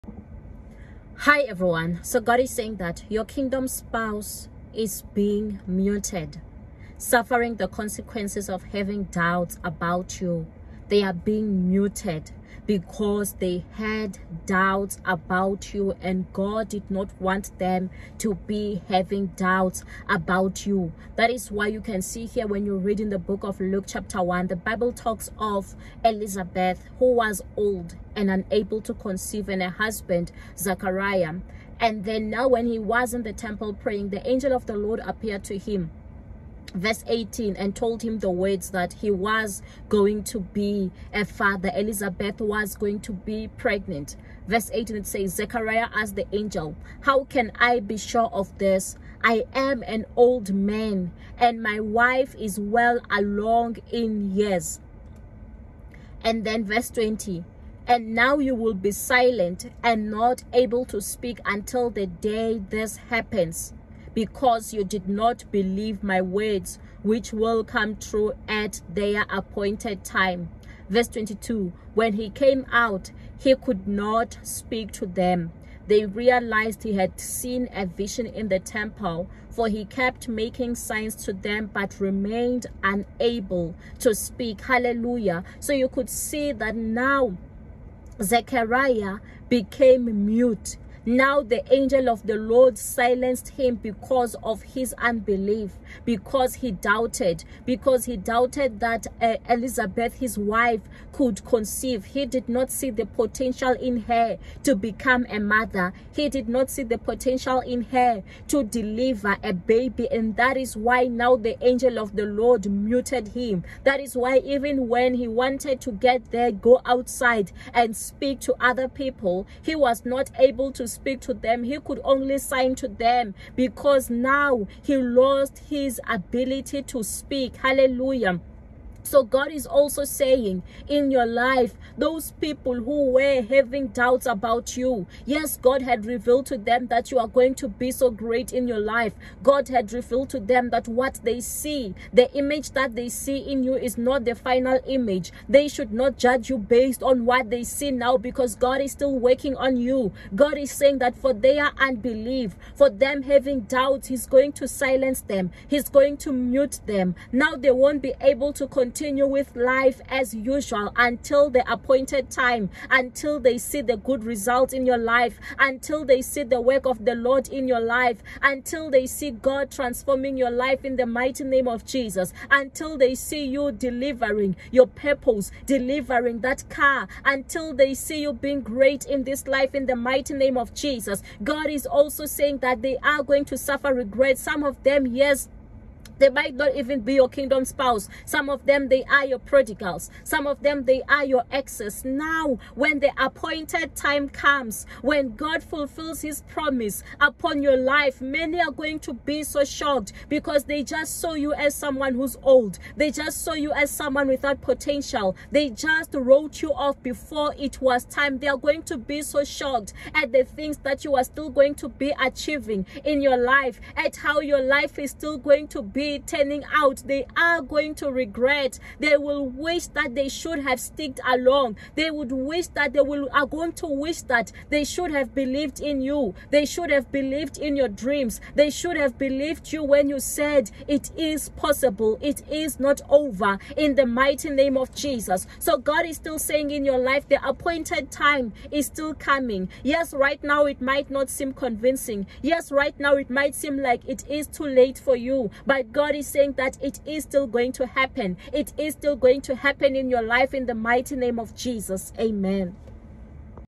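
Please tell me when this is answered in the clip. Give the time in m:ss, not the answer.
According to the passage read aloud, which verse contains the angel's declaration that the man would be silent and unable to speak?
0:56.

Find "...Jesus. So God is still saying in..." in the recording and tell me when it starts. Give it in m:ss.
3:54.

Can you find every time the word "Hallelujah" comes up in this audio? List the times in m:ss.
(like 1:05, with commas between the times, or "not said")
1:24, 2:07.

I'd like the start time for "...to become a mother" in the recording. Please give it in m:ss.
1:44.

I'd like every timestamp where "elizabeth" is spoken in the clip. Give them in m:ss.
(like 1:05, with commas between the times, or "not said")
0:26, 0:41, 1:39.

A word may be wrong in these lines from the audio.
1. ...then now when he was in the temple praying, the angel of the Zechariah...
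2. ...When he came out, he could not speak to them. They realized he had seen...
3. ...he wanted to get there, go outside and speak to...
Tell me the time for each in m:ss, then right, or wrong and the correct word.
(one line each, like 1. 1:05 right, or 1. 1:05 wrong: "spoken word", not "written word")
1. 0:32 wrong: "Lord", not "Zechariah"
2. 1:11 right
3. 1:55 right.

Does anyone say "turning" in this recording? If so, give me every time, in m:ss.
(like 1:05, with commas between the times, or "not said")
3:36.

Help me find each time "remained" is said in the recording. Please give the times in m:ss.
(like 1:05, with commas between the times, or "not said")
1:21.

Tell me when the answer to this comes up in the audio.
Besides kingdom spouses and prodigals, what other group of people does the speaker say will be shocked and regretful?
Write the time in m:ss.
3:11.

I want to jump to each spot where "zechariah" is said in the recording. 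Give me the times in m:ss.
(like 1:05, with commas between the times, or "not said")
0:45, 1:28.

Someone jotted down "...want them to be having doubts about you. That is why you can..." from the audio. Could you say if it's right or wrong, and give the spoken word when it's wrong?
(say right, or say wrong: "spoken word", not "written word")
right.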